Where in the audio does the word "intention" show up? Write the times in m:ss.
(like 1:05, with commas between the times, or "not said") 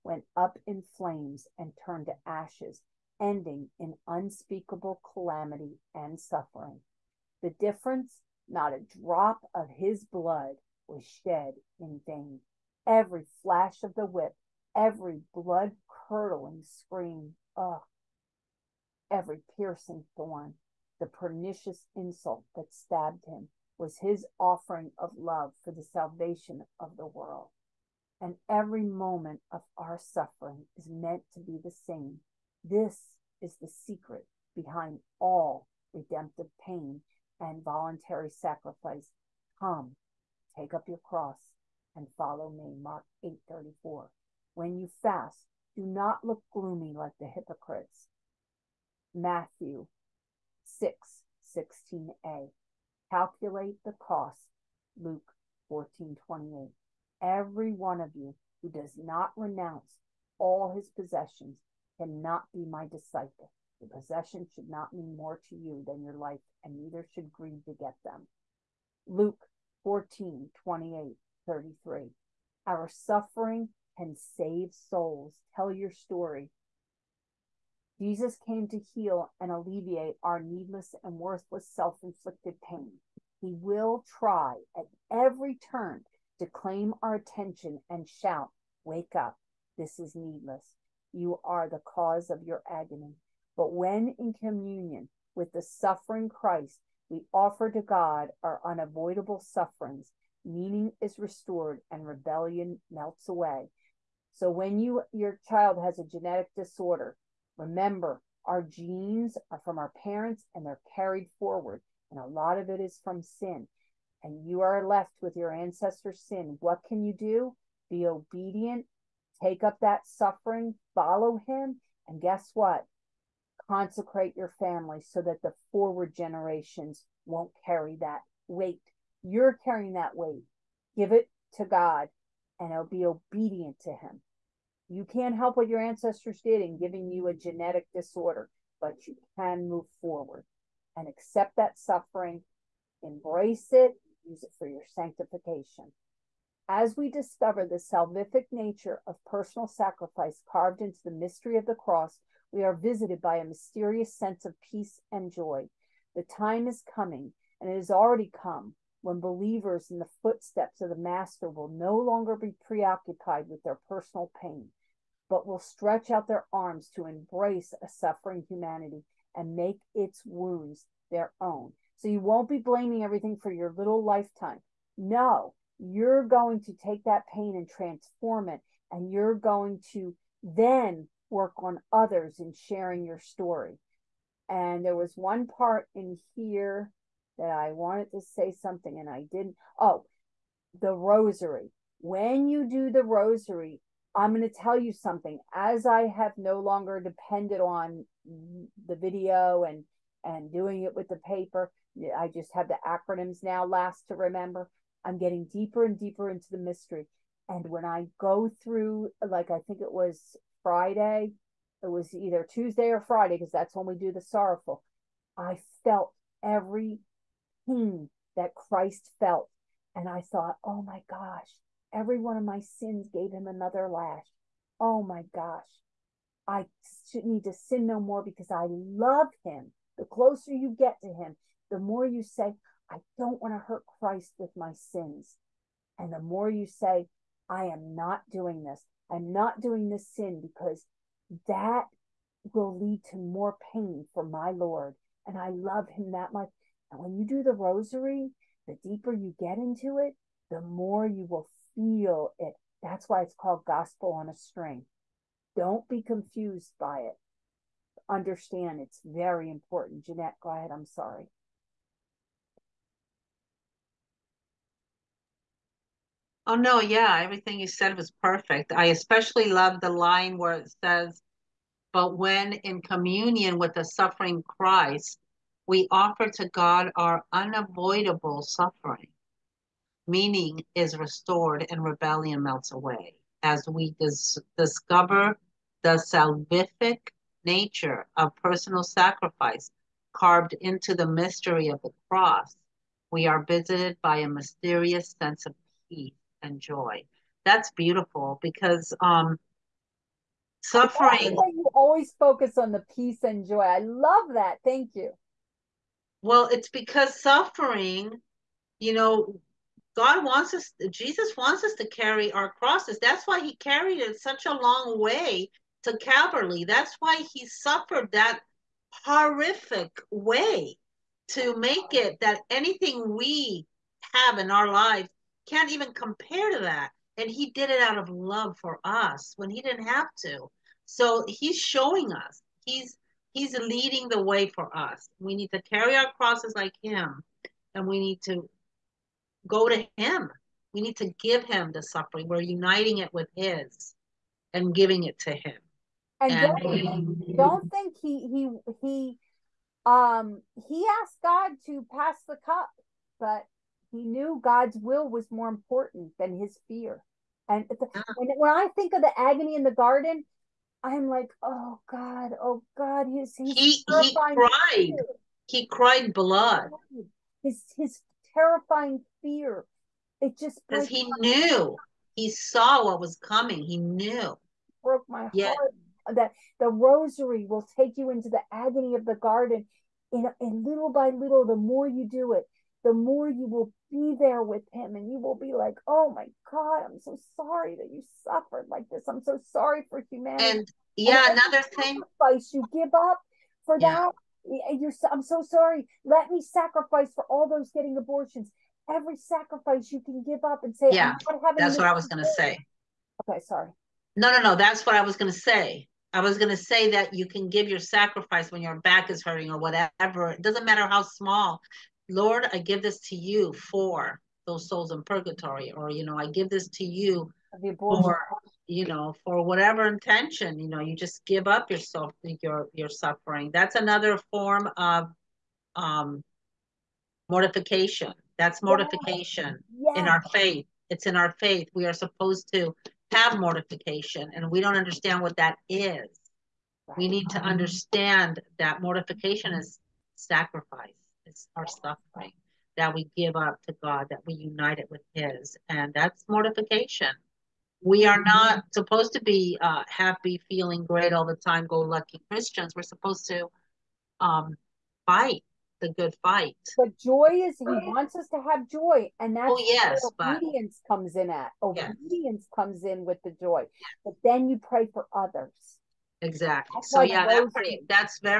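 6:59.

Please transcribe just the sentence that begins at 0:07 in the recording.
The difference, not a drop of his blood was shed in vain.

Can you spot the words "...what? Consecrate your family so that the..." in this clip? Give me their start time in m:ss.
2:02.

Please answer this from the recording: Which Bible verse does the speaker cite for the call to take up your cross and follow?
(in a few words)
Mark 8:34.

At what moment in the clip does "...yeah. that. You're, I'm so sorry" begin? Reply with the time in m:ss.
6:33.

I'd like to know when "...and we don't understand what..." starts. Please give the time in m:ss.
7:14.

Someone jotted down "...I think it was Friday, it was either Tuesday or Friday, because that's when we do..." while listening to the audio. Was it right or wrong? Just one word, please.
right.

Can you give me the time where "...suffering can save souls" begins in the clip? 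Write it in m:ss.
1:12.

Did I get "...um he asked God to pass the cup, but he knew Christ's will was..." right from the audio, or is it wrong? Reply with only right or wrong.
wrong.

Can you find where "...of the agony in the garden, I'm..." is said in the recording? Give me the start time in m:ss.
5:58.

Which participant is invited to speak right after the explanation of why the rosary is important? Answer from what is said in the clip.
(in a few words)
Jeanette.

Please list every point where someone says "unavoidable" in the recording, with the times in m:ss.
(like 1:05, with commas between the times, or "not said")
1:38, 4:37.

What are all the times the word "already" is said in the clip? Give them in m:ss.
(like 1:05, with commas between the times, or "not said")
2:37.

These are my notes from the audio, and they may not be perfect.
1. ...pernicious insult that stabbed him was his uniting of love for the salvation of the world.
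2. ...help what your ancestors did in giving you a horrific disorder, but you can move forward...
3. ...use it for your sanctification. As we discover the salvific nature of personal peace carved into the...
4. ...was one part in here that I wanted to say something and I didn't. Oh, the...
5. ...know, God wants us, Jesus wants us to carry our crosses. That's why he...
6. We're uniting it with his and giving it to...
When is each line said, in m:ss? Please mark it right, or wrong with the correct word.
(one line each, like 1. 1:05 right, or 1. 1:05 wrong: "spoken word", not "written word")
1. 0:21 wrong: "offering", not "uniting"
2. 2:15 wrong: "genetic", not "horrific"
3. 2:24 wrong: "sacrifice", not "peace"
4. 3:04 right
5. 5:08 right
6. 5:42 right.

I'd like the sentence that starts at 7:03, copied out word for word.
That's another form of um, mortification.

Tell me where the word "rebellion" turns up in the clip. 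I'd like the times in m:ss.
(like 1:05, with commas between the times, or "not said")
1:42, 4:41.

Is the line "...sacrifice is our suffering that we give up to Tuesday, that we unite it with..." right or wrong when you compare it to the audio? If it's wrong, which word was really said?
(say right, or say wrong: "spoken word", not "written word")
wrong: "God", not "Tuesday".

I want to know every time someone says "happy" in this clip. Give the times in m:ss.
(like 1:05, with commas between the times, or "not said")
7:29.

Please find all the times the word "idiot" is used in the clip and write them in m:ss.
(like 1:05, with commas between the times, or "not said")
not said.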